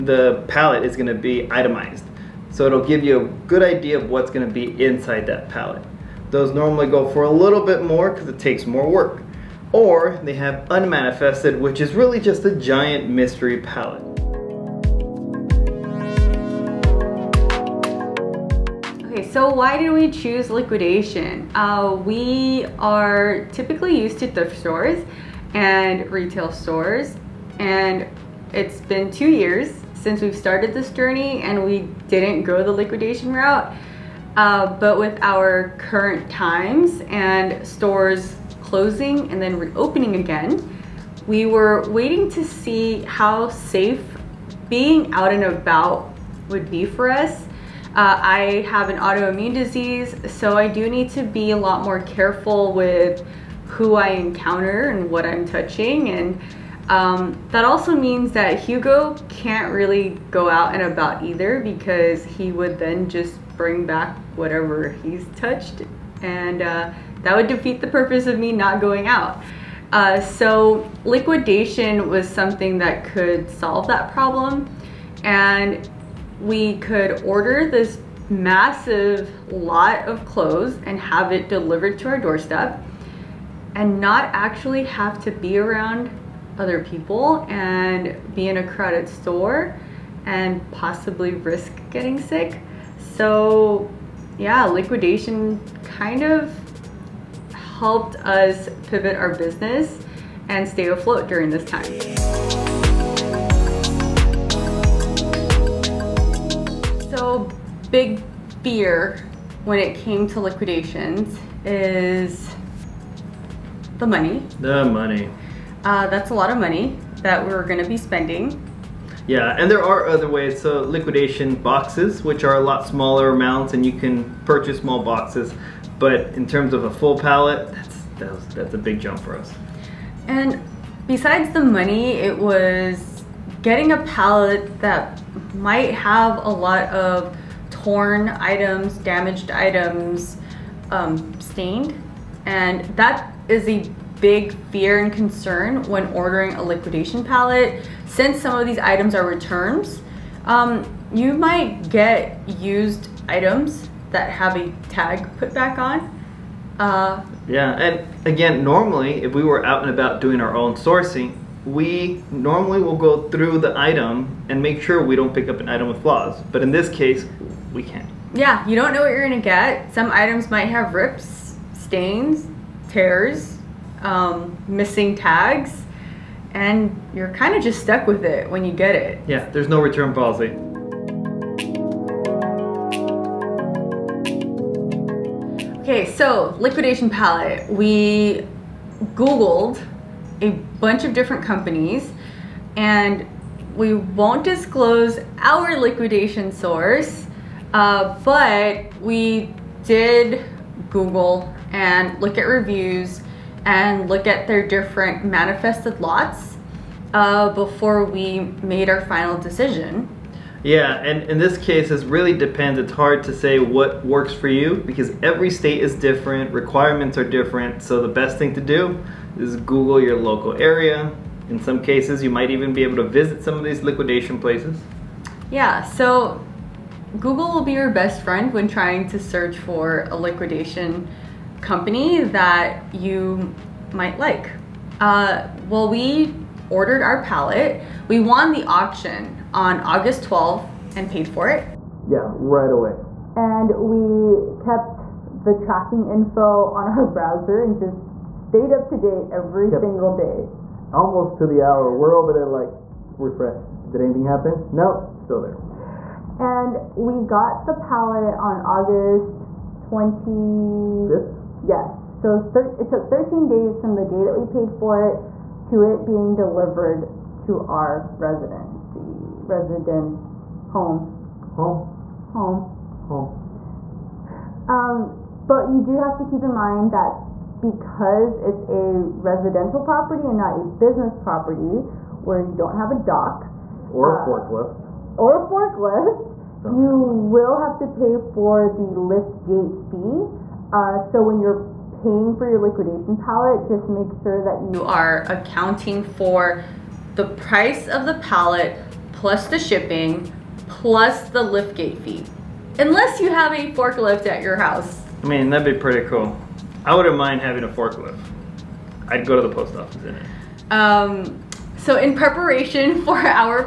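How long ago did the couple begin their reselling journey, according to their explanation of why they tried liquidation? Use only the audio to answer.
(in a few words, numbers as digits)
2 years.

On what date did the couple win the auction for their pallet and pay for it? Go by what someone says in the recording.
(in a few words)
August 12.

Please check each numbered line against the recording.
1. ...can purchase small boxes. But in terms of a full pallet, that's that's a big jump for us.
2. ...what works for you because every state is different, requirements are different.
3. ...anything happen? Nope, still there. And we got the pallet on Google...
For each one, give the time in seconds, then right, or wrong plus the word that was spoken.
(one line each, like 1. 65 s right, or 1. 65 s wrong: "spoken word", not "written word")
1. 123 s right
2. 213 s right
3. 254 s wrong: "August", not "Google".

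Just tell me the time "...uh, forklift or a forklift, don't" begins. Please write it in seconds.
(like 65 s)
284 s.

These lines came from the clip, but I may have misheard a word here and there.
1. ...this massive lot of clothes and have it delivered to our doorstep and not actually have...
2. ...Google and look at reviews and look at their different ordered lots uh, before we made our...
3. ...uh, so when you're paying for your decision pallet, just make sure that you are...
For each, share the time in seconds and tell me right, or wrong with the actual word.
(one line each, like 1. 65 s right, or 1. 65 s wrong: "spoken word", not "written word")
1. 77 s right
2. 200 s wrong: "manifested", not "ordered"
3. 290 s wrong: "liquidation", not "decision".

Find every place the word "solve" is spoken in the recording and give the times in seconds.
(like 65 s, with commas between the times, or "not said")
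73 s.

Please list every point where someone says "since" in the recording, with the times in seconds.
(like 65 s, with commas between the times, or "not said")
29 s, 148 s.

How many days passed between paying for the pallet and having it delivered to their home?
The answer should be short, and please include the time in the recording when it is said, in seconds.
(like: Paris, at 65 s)
13, at 263 s.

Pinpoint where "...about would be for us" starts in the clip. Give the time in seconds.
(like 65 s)
45 s.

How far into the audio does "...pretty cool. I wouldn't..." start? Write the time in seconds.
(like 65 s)
305 s.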